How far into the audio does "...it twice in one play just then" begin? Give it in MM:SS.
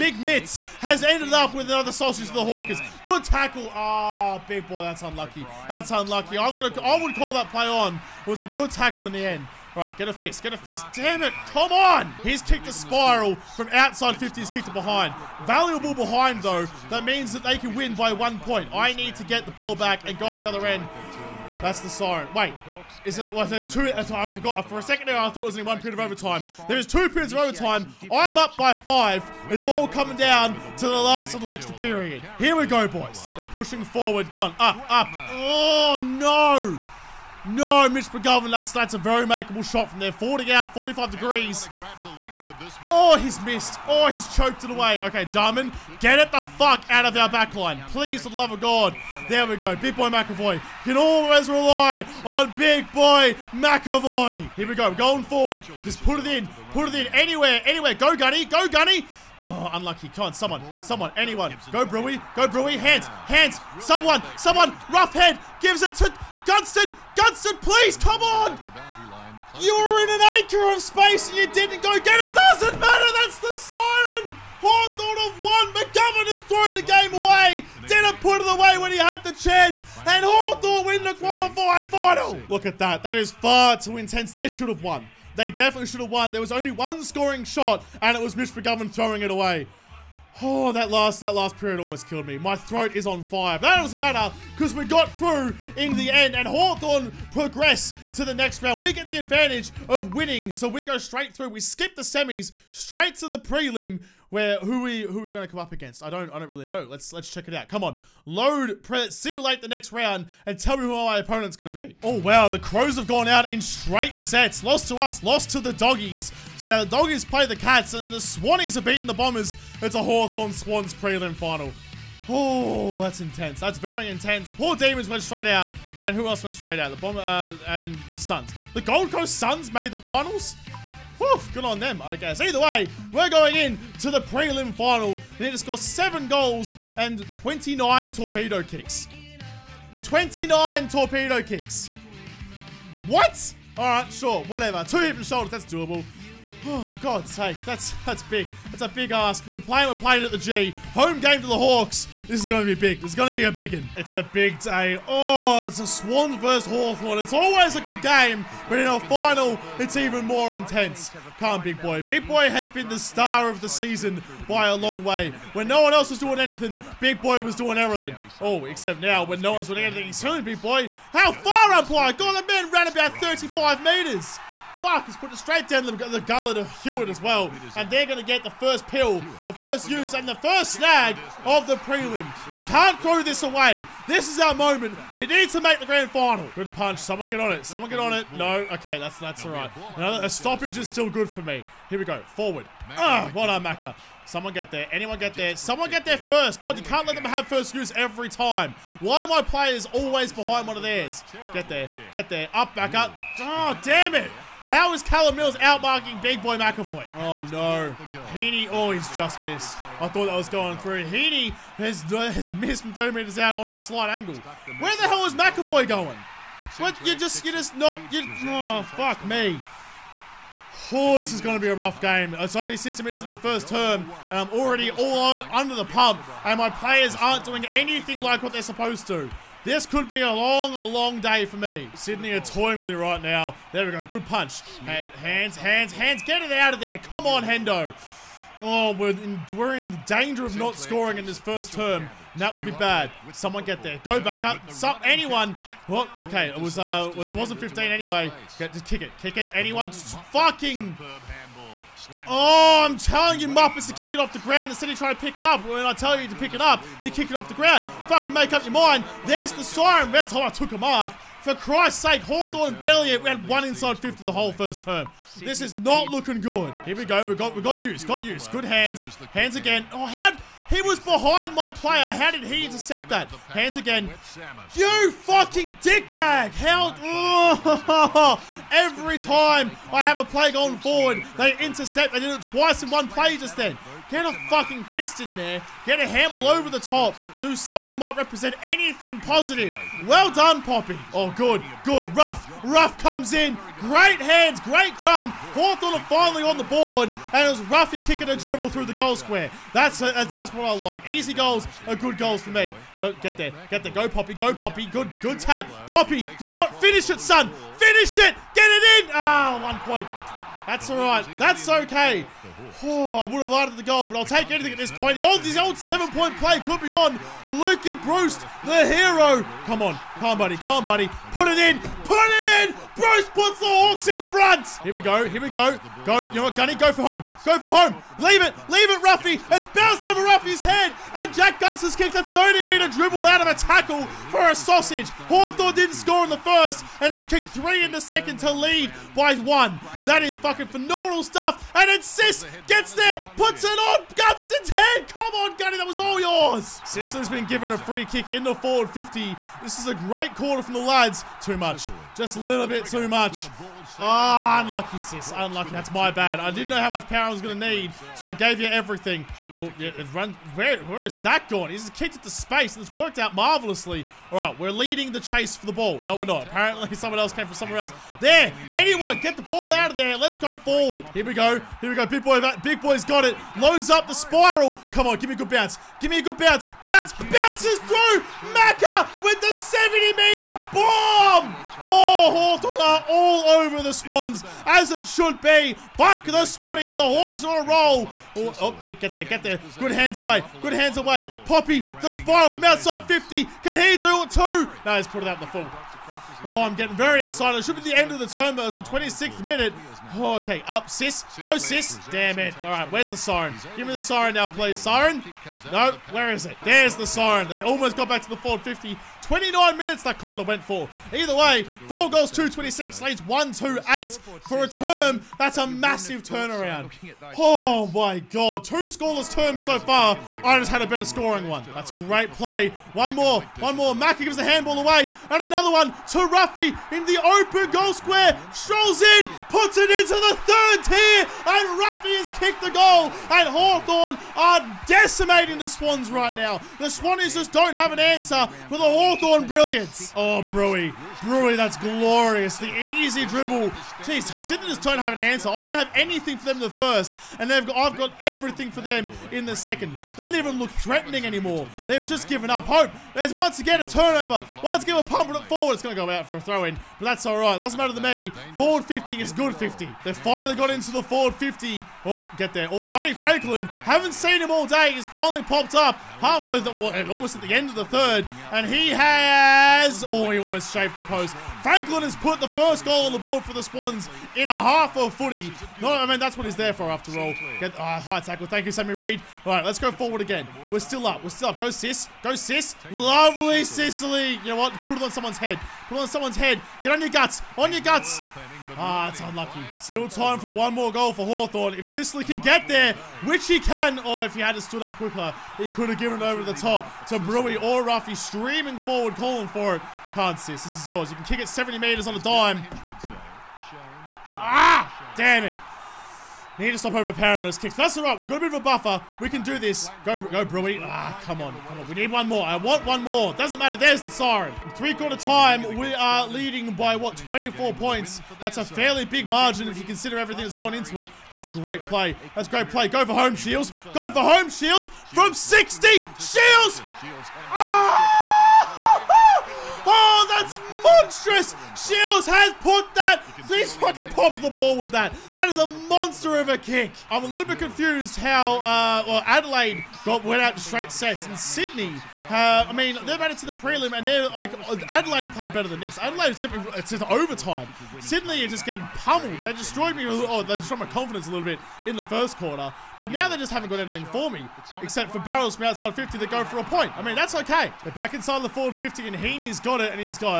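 04:42.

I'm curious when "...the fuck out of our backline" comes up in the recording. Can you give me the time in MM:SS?
00:46.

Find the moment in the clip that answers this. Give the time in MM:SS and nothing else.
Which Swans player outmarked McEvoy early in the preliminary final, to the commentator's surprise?
03:25.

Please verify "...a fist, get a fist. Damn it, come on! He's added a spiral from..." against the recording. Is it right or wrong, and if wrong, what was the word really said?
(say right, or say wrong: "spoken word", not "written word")
wrong: "kicked", not "added".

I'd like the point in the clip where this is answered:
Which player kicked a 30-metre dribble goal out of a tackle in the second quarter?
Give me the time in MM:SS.
05:31.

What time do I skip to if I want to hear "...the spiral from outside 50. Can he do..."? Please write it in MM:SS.
06:32.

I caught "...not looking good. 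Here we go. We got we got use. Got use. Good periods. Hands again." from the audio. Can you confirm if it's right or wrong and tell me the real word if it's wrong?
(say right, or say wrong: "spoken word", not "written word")
wrong: "hands", not "periods".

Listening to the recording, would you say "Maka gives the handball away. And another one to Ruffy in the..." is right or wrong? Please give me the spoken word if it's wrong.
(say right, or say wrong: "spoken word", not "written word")
right.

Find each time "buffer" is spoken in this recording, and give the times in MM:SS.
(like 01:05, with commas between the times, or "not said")
08:28.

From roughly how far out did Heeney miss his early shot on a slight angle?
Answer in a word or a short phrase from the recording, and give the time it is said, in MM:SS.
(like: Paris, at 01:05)
30 metres, at 03:32.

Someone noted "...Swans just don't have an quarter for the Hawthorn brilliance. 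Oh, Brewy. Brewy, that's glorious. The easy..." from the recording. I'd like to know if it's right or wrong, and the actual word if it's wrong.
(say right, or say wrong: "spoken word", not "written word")
wrong: "answer", not "quarter".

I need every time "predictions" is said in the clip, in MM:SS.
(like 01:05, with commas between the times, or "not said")
not said.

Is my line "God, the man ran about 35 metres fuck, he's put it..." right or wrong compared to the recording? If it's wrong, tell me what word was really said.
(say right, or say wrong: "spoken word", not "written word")
right.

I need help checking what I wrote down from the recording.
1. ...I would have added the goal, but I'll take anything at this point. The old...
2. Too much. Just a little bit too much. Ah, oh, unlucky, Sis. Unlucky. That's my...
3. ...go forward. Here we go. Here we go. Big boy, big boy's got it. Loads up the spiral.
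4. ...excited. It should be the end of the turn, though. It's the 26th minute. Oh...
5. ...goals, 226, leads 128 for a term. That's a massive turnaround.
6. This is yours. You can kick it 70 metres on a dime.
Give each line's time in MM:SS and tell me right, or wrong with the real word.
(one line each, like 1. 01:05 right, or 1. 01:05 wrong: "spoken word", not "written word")
1. 05:13 right
2. 05:51 right
3. 06:10 right
4. 06:37 right
5. 06:52 right
6. 08:20 right.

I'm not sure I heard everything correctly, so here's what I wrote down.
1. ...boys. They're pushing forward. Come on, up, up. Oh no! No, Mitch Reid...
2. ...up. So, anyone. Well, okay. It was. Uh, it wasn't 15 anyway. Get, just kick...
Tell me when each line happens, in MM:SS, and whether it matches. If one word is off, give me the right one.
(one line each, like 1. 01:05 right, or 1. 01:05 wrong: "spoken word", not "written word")
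1. 00:32 wrong: "McGovern", not "Reid"
2. 04:04 right.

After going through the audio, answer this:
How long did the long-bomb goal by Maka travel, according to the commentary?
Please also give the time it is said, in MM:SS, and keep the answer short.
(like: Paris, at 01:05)
70 metres, at 06:19.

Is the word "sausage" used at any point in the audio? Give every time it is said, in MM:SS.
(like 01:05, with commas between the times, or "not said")
00:01, 05:34.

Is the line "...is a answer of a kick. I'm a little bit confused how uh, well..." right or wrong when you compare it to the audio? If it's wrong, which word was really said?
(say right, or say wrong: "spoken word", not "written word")
wrong: "monster", not "answer".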